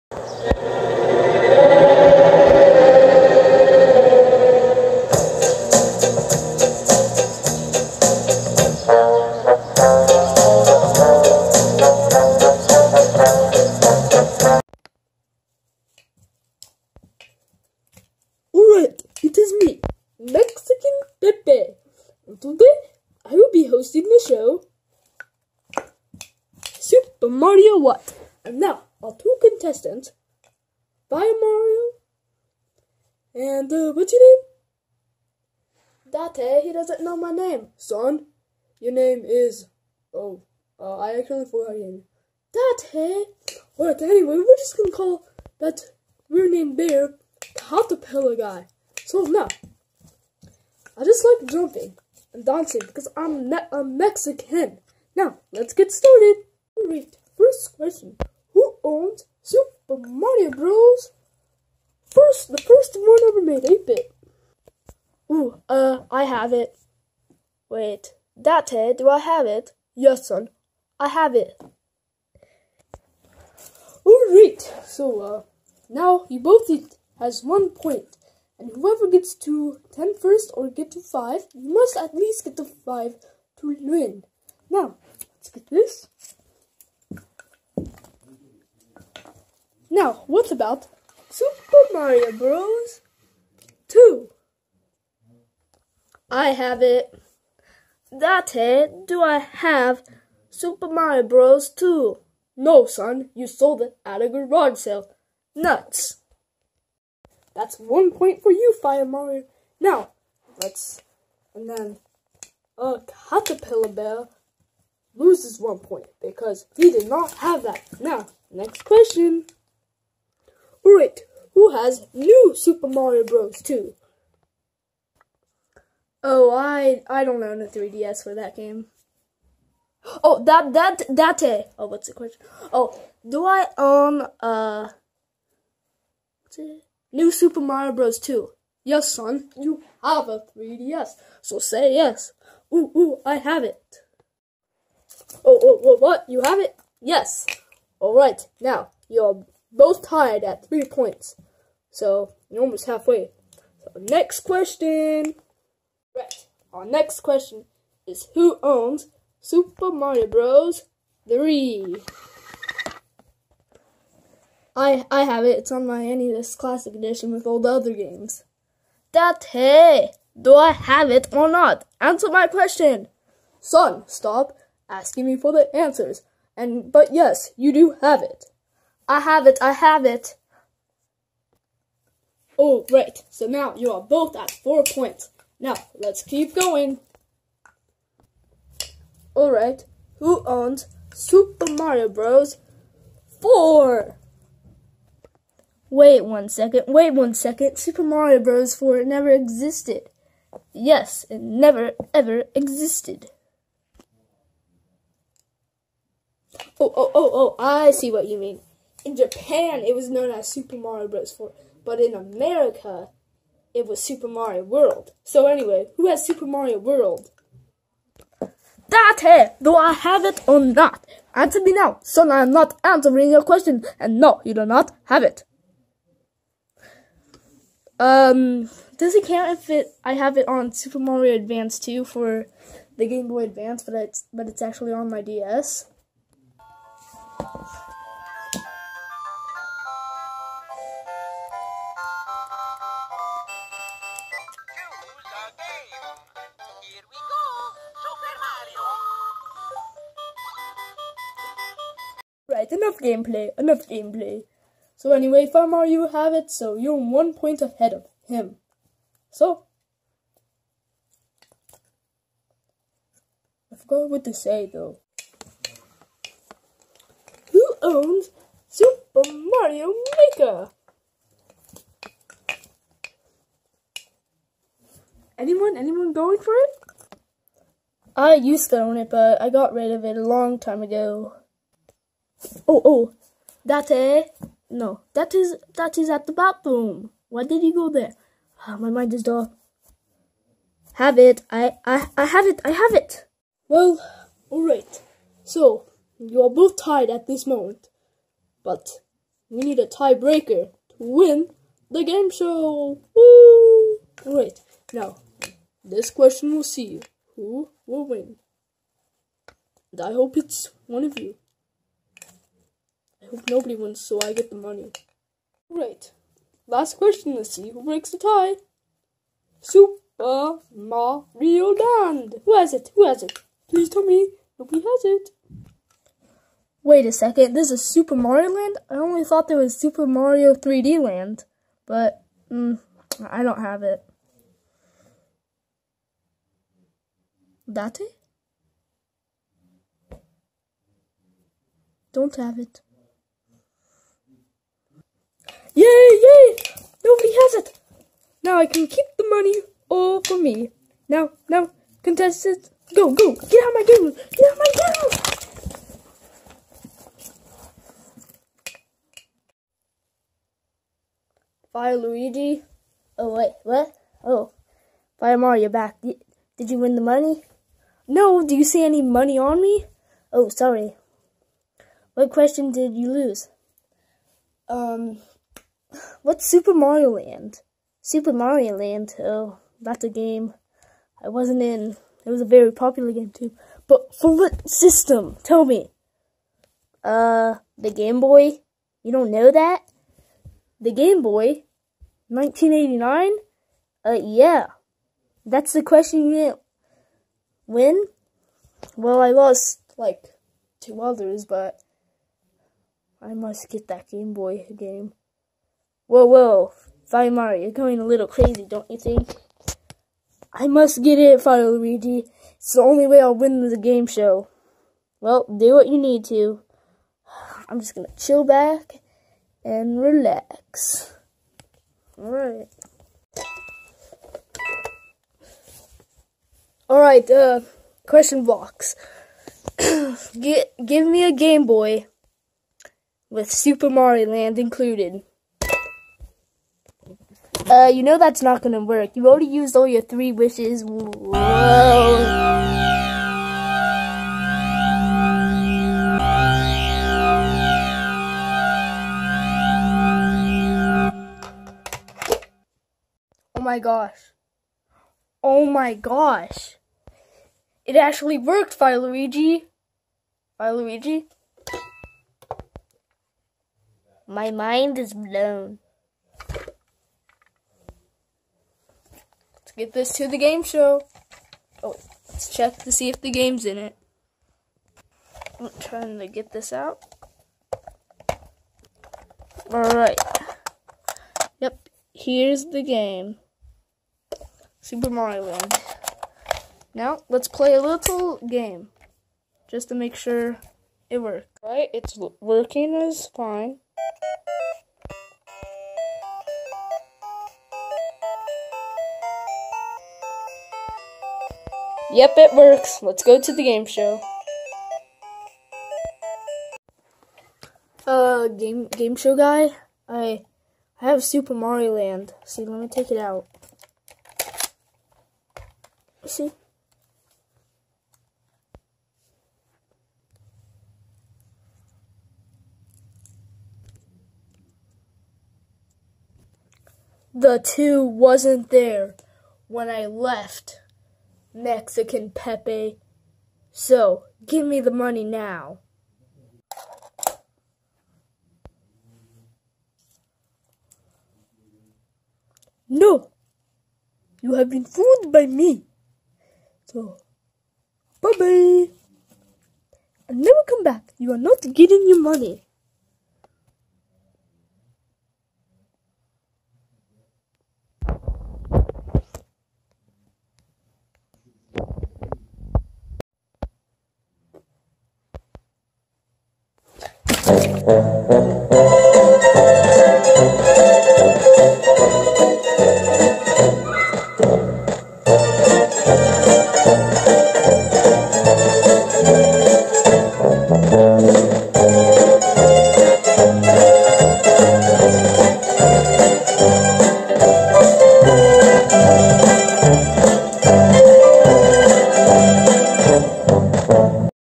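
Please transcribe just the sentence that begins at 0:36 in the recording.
Date, he doesn't know my name.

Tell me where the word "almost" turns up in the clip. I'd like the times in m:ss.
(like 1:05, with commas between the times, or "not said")
2:32.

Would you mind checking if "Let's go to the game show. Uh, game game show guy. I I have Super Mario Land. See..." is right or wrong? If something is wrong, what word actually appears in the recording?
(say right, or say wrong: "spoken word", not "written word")
right.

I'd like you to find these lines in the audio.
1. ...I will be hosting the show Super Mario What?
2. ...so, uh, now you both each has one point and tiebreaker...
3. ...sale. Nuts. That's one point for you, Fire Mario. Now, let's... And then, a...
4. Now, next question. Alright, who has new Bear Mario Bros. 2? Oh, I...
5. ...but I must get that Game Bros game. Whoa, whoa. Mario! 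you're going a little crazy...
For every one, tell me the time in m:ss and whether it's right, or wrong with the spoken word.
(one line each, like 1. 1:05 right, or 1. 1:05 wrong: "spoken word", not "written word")
1. 0:23 right
2. 1:14 wrong: "whoever", not "tiebreaker"
3. 1:44 right
4. 1:57 wrong: "Super", not "Bear"
5. 6:41 wrong: "Boy", not "Bros".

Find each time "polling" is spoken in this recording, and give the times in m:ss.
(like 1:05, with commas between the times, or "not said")
not said.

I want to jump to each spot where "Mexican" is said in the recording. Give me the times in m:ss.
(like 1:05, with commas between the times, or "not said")
0:53, 8:51.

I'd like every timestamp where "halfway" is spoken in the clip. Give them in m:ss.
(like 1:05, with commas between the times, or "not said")
2:32.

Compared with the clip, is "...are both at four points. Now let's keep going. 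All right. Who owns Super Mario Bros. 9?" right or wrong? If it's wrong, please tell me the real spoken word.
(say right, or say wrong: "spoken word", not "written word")
wrong: "4", not "9".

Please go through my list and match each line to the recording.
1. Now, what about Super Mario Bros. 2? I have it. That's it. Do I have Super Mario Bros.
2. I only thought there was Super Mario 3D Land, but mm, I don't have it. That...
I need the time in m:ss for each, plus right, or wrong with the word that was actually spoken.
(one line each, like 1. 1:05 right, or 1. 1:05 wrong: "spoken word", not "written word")
1. 1:29 right
2. 5:28 right.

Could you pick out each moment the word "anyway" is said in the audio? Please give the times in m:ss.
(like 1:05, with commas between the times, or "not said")
0:44, 3:35, 4:15.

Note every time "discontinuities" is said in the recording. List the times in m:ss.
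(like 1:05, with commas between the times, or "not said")
not said.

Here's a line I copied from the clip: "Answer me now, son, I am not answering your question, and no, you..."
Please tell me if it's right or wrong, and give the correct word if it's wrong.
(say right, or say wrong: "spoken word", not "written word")
right.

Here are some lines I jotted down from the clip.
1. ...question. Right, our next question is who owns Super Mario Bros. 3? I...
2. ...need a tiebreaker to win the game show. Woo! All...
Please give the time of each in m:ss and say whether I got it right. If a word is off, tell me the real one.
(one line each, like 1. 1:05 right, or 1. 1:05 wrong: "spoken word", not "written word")
1. 2:34 right
2. 4:59 right.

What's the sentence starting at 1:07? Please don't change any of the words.
Wait, that head, do I have it?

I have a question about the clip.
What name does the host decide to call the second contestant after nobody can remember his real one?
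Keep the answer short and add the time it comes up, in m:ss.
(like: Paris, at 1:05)
Caterpillar Guy, at 0:47.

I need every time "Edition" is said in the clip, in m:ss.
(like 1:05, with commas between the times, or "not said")
2:46.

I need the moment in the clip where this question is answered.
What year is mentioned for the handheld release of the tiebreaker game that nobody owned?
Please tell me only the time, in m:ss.
6:32.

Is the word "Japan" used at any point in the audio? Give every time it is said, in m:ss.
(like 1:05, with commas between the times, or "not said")
3:29.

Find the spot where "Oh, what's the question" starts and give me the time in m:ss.
2:11.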